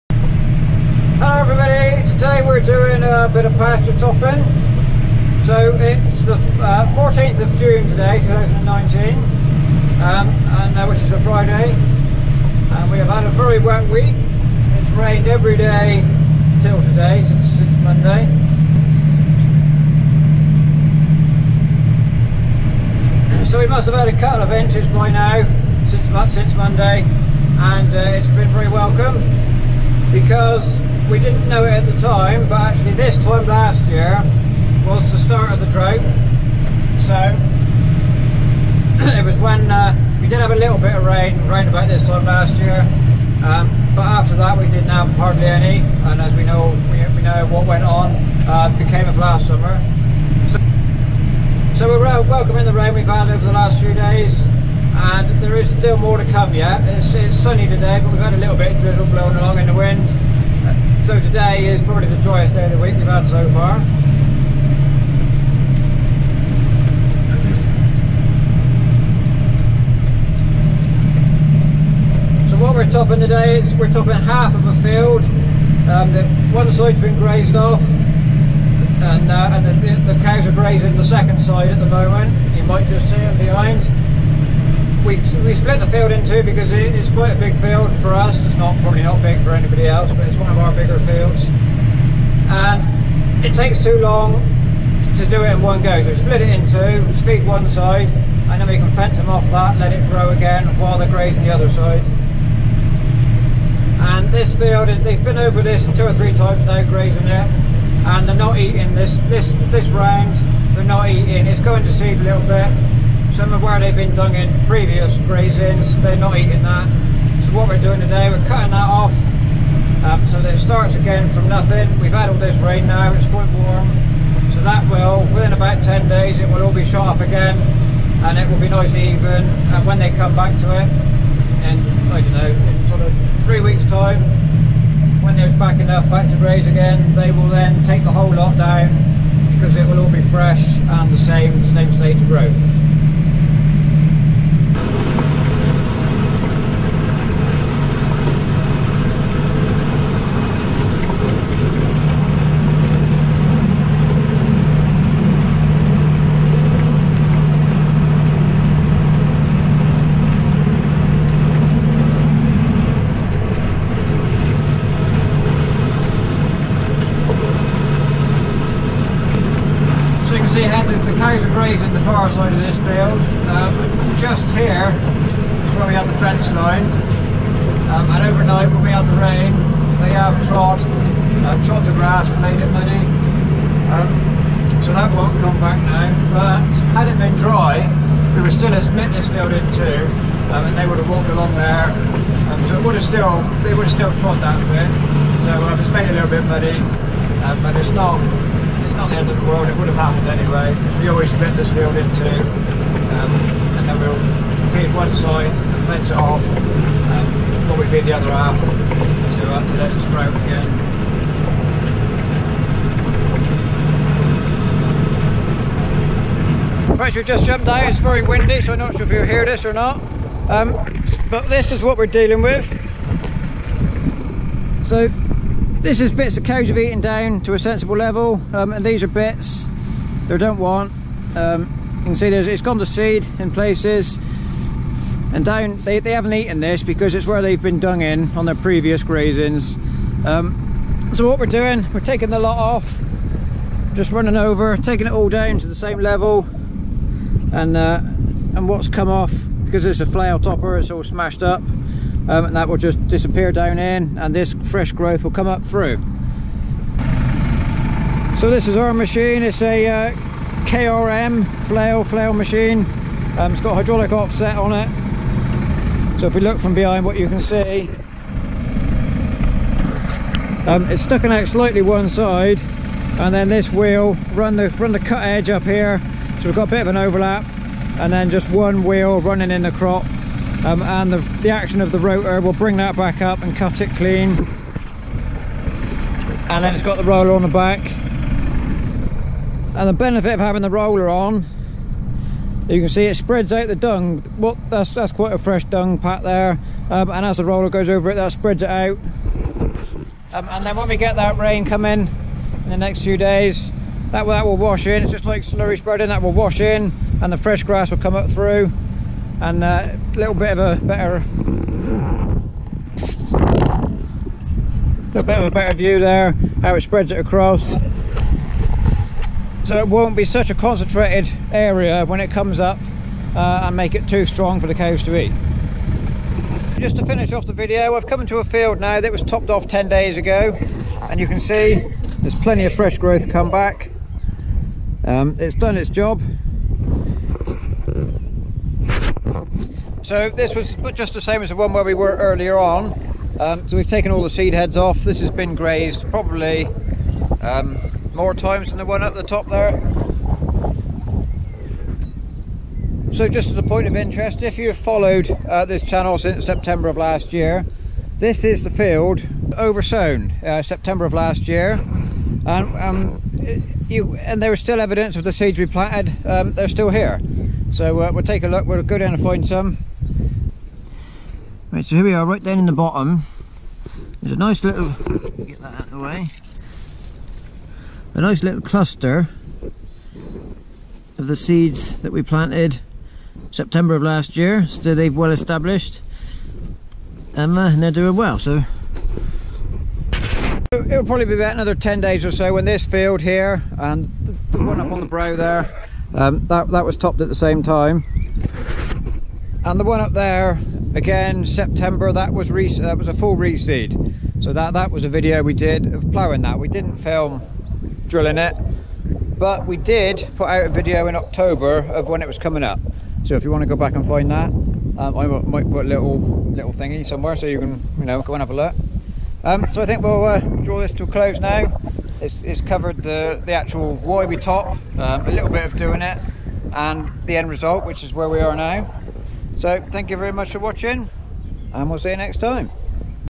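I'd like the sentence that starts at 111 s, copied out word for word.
It's going to seed a little bit, some of where they've been done in previous grazings, they're not eating that.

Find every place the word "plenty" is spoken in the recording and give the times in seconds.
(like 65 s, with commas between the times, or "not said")
332 s.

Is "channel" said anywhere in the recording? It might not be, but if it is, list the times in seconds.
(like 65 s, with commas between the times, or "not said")
355 s.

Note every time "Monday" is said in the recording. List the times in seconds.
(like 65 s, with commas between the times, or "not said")
17 s, 26 s.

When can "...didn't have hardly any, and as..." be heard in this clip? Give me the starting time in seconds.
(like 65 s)
44 s.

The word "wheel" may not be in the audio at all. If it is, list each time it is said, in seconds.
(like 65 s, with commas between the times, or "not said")
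273 s, 278 s.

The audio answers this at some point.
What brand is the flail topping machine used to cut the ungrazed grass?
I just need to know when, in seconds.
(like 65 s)
260 s.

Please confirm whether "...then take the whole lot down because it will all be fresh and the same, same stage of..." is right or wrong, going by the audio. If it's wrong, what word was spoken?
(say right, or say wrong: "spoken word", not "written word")
right.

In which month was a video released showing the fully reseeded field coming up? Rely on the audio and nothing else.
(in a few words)
October.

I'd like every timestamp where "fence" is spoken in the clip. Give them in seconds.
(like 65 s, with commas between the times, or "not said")
98 s, 176 s, 205 s.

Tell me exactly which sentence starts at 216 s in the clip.
Right, we've just jumped out, it's very windy, so I'm not sure if you hear this or not.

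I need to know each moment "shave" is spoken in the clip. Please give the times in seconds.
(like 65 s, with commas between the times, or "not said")
not said.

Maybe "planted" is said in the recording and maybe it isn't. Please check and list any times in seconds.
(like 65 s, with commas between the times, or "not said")
365 s, 382 s.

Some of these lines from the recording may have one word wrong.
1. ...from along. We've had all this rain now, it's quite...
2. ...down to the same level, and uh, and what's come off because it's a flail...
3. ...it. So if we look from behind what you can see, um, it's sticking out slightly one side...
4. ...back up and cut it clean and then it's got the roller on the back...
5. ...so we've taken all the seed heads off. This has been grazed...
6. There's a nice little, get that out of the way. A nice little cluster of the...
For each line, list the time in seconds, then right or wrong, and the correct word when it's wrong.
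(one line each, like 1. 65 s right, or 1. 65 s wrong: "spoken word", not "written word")
1. 121 s wrong: "nothing", not "along"
2. 245 s right
3. 264 s right
4. 282 s right
5. 343 s right
6. 374 s right.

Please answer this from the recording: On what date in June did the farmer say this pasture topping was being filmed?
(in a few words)
14th of June 2019.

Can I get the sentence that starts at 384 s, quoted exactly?
So they've well established and, uh, and they're doing well.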